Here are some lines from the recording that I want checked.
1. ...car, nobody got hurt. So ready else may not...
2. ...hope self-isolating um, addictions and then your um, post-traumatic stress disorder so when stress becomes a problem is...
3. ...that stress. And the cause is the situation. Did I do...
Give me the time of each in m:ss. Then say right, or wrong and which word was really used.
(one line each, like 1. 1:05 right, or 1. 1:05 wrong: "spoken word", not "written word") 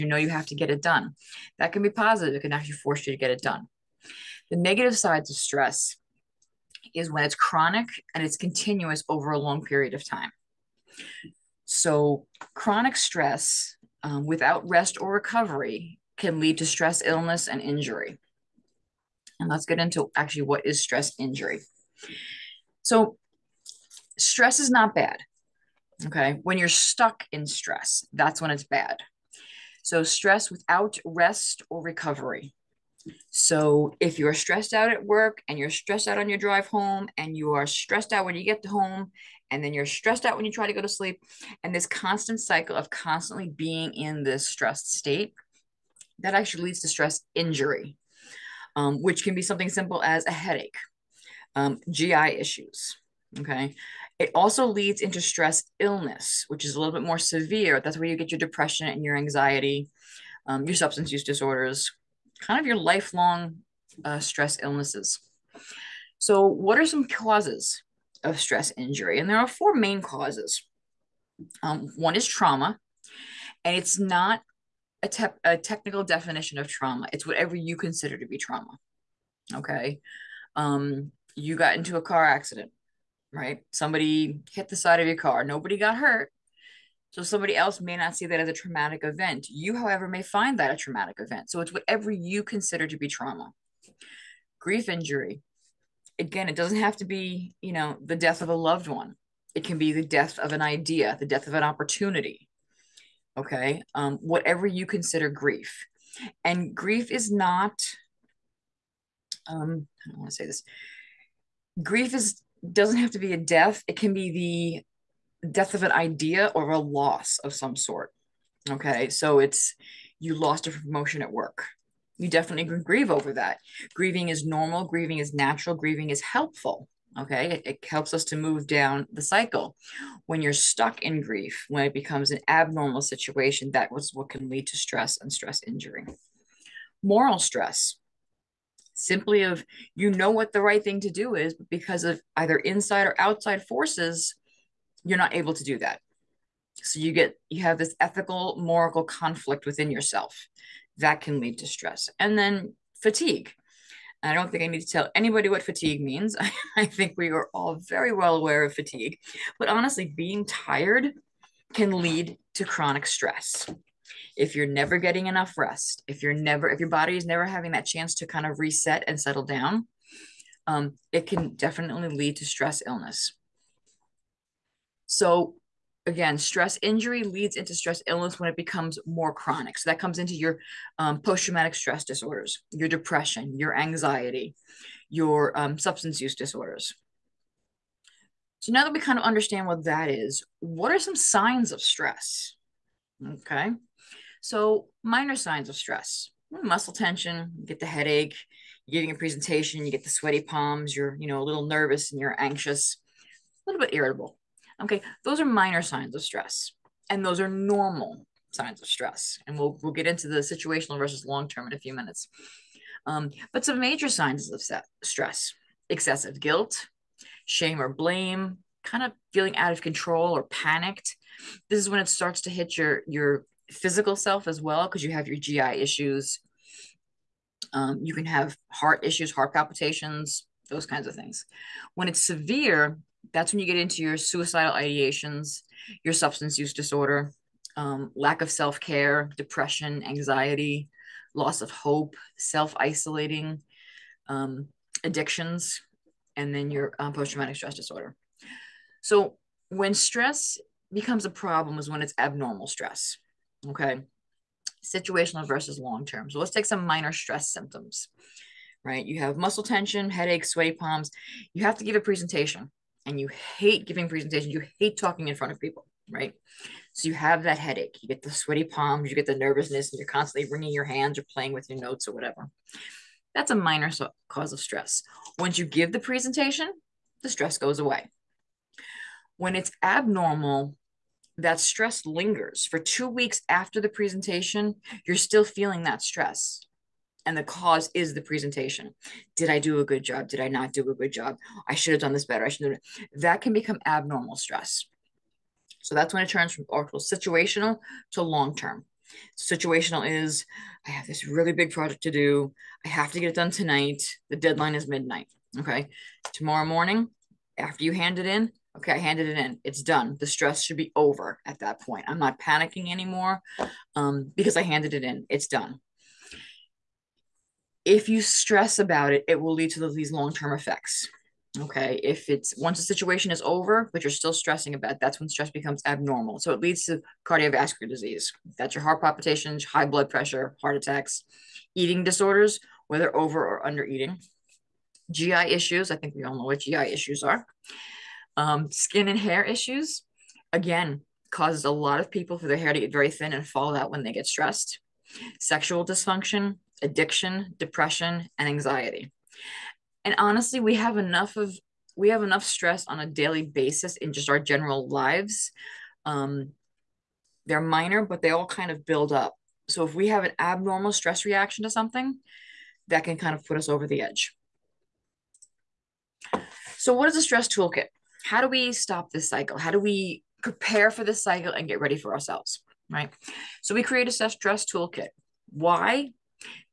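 1. 1:25 wrong: "somebody", not "ready"
2. 4:01 right
3. 4:45 wrong: "presentation", not "situation".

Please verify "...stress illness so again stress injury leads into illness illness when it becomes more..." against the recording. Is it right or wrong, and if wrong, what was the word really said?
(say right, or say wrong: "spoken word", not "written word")
wrong: "stress", not "illness".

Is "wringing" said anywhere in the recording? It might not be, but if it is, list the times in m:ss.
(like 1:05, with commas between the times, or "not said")
4:30.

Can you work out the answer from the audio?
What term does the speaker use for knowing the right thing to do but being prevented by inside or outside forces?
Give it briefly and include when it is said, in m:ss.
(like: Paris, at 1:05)
Moral stress, at 2:17.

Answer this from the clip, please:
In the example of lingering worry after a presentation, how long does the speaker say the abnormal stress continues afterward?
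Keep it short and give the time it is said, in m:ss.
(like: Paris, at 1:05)
2 weeks, at 4:42.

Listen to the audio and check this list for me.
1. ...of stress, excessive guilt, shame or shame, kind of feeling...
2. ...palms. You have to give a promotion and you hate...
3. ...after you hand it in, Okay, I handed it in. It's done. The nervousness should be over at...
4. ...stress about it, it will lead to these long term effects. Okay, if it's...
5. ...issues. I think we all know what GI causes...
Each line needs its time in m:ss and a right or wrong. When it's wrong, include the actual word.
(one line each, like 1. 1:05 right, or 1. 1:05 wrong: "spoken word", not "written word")
1. 3:34 wrong: "blame", not "shame"
2. 4:20 wrong: "presentation", not "promotion"
3. 5:07 wrong: "stress", not "nervousness"
4. 5:18 right
5. 5:35 wrong: "issues", not "causes".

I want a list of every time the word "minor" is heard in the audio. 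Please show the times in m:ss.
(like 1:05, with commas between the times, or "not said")
3:15, 3:25, 4:16, 4:33, 5:57.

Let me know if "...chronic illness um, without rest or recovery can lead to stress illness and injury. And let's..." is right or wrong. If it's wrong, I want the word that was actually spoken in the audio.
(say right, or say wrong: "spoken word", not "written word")
wrong: "stress", not "illness".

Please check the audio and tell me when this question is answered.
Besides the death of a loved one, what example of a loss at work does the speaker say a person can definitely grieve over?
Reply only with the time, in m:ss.
2:00.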